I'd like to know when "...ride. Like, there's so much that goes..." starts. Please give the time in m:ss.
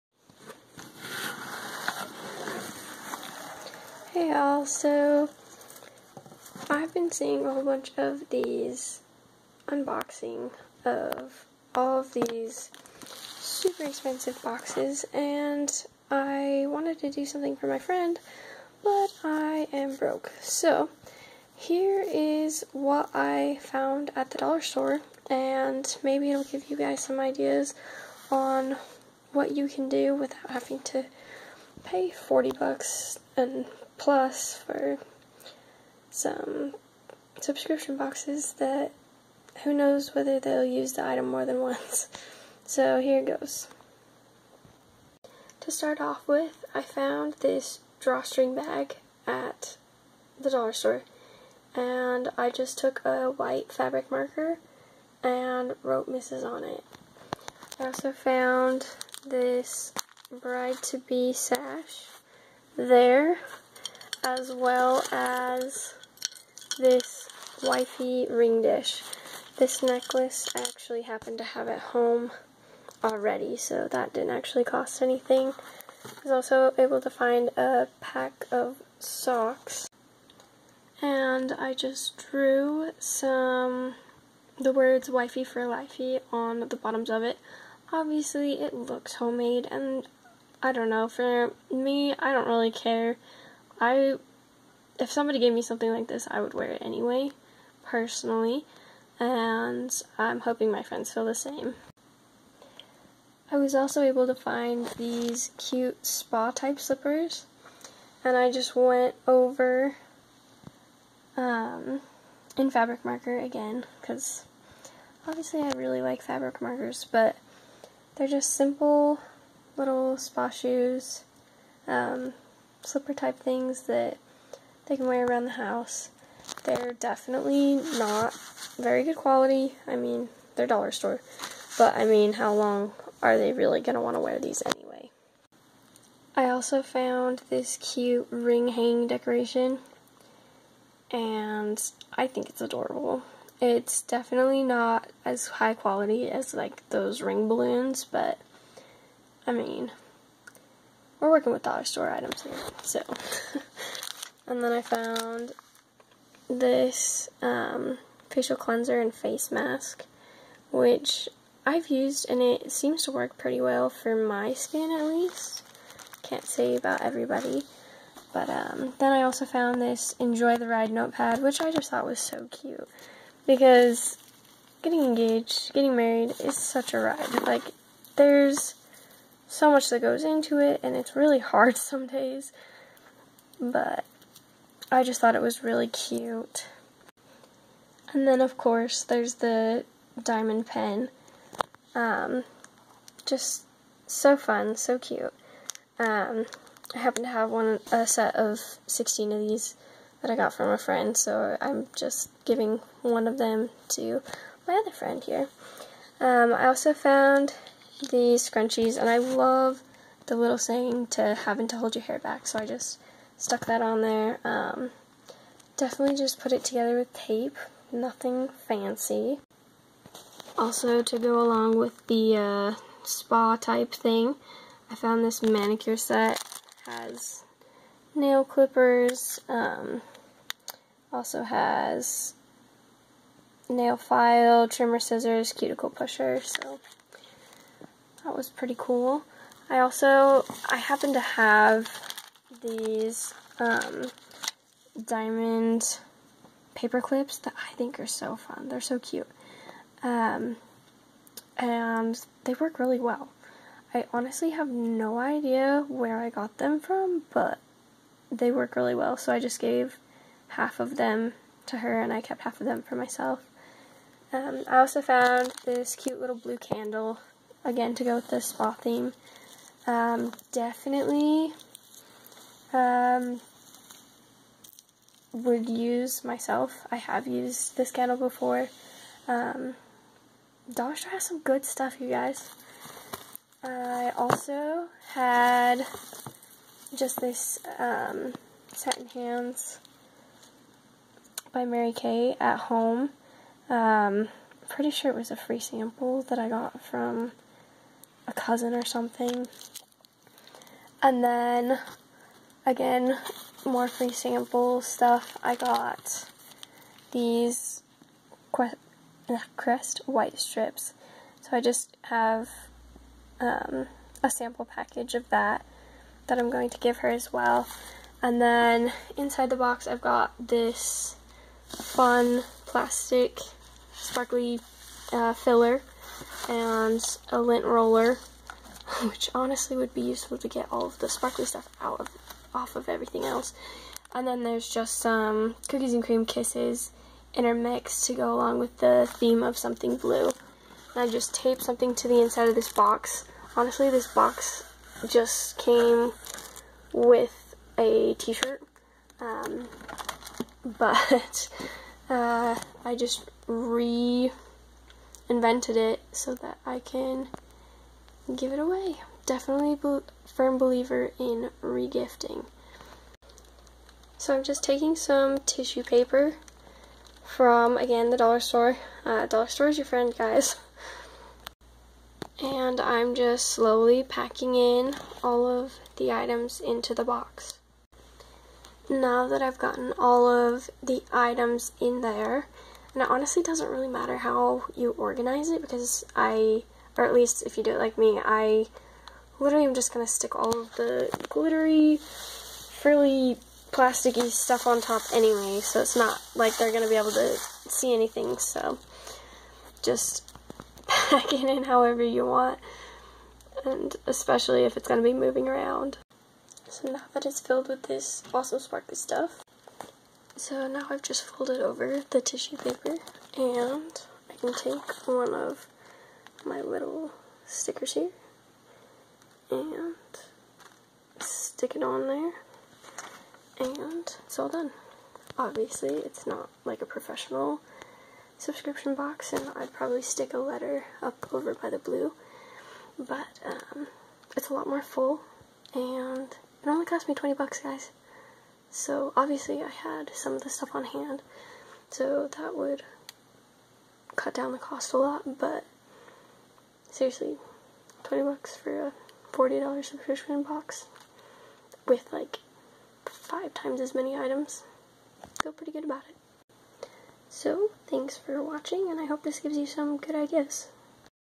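2:56.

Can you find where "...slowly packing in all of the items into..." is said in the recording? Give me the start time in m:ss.
6:13.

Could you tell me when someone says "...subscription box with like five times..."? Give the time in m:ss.
7:29.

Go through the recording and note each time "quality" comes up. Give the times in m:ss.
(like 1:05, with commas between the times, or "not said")
2:09, 2:25.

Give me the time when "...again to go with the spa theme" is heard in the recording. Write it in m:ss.
4:27.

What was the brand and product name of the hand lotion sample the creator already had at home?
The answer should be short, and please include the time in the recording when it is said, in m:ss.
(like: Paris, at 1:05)
Satin Hands by Mary Kay, at 4:48.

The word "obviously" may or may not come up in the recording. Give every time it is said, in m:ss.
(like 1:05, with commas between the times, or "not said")
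1:27, 1:55, 7:05, 7:19.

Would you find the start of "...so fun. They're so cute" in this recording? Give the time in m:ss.
4:08.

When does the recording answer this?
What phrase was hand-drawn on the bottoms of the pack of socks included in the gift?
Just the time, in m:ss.
1:25.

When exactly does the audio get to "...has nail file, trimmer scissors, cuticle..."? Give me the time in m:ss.
3:51.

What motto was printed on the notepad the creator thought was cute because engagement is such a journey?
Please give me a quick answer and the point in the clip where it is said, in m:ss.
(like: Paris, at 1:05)
Enjoy the Ride, at 2:50.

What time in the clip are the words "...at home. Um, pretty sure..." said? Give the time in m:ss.
4:52.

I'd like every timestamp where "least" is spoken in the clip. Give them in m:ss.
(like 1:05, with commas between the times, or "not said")
2:45, 6:27.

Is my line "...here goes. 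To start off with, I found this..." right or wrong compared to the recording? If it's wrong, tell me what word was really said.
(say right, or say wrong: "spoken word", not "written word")
right.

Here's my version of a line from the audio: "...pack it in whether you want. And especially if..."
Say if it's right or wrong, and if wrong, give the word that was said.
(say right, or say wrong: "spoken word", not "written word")
wrong: "however", not "whether".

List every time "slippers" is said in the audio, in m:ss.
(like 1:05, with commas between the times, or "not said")
1:46, 2:02.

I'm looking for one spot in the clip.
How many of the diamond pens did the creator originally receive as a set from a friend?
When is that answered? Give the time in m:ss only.
3:18.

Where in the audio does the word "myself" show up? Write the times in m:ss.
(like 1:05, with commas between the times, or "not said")
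4:22, 4:36.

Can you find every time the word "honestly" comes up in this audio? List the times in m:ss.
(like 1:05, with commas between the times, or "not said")
4:14, 5:29, 5:43, 6:23.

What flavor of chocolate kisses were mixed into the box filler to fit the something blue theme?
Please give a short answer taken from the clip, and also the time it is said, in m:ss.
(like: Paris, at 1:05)
cookies and cream, at 5:35.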